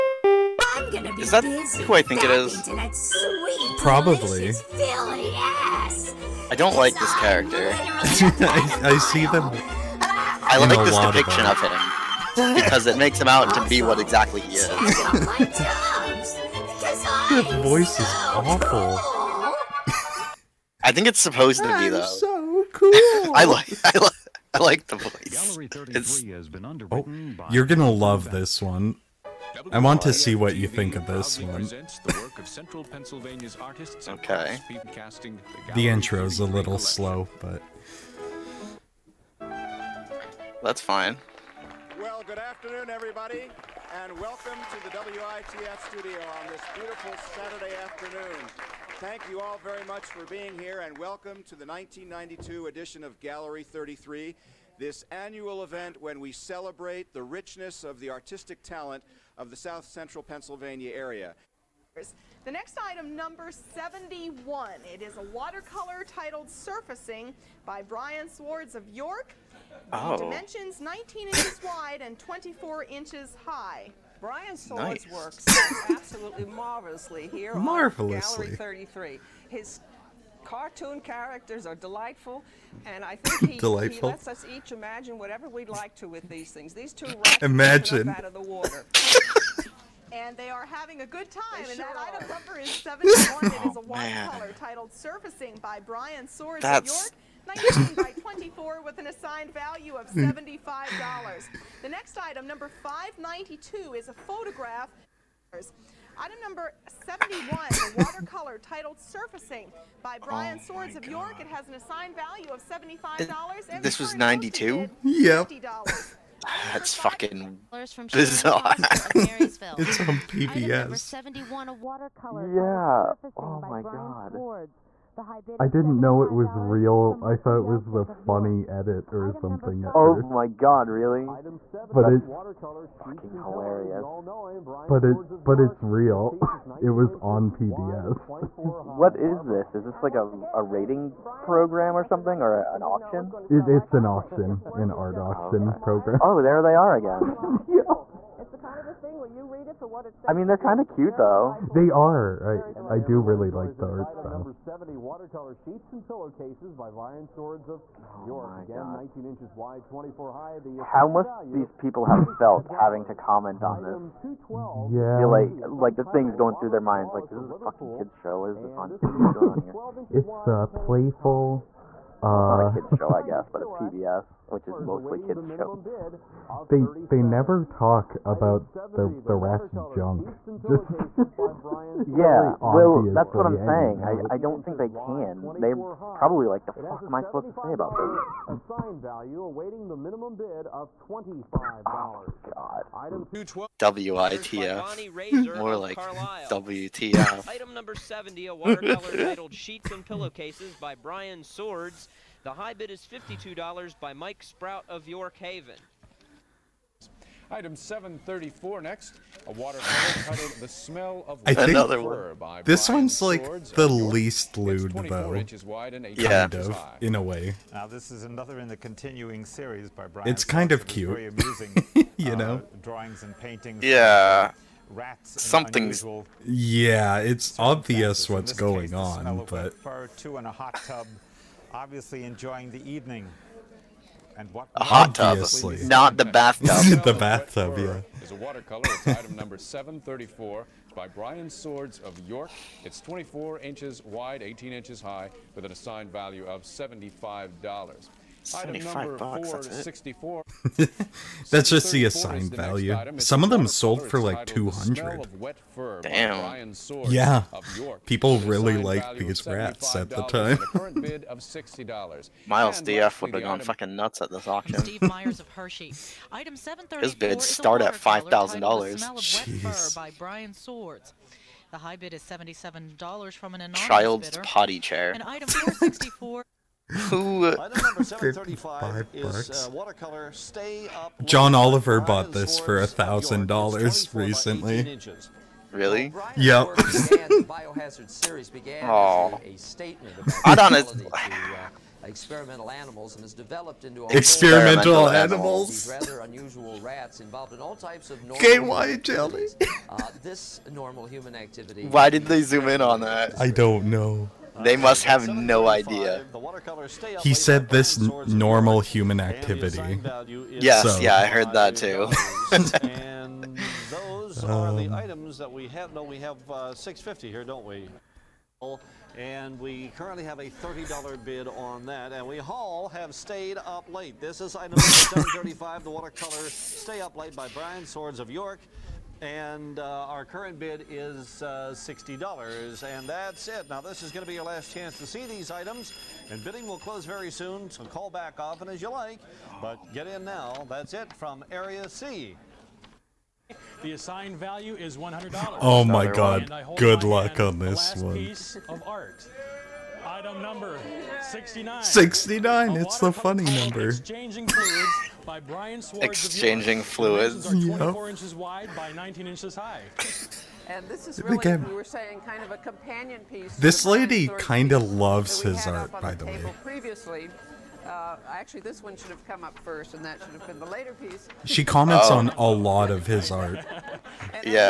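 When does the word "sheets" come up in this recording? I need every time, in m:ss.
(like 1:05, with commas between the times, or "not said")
2:35, 3:19.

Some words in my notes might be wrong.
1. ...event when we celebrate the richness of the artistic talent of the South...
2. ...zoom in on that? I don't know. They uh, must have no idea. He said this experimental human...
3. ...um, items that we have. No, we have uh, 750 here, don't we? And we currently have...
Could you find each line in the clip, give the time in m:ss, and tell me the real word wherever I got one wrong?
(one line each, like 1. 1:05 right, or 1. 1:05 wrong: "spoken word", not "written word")
1. 0:55 right
2. 5:02 wrong: "normal", not "experimental"
3. 5:14 wrong: "650", not "750".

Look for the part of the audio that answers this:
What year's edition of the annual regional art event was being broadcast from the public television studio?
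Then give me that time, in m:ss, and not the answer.
0:51.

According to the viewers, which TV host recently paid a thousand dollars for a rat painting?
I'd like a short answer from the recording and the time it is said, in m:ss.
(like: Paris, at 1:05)
John Oliver, at 4:41.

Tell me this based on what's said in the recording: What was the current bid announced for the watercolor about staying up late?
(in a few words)
$60.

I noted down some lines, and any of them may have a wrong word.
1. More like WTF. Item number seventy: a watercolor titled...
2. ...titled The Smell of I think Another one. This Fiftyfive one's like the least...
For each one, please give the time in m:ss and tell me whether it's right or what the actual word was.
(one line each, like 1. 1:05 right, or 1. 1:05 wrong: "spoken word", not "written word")
1. 3:15 right
2. 3:30 wrong: "Brian", not "Fiftyfive".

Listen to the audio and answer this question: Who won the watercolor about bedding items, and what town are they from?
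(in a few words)
Mike Sprout of York Haven.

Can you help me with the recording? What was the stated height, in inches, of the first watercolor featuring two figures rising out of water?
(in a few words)
24 inches.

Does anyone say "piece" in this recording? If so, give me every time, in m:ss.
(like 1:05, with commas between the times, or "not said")
6:03, 6:10.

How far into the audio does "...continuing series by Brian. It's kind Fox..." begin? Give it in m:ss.
3:38.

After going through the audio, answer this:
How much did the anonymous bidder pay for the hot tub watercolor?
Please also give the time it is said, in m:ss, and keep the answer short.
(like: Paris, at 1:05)
$77, at 4:32.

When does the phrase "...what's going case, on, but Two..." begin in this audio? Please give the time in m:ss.
3:48.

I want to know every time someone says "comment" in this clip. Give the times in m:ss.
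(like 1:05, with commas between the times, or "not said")
2:43, 6:11.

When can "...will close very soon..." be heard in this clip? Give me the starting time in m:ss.
5:36.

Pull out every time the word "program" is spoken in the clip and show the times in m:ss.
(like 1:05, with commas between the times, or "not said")
2:21, 2:25.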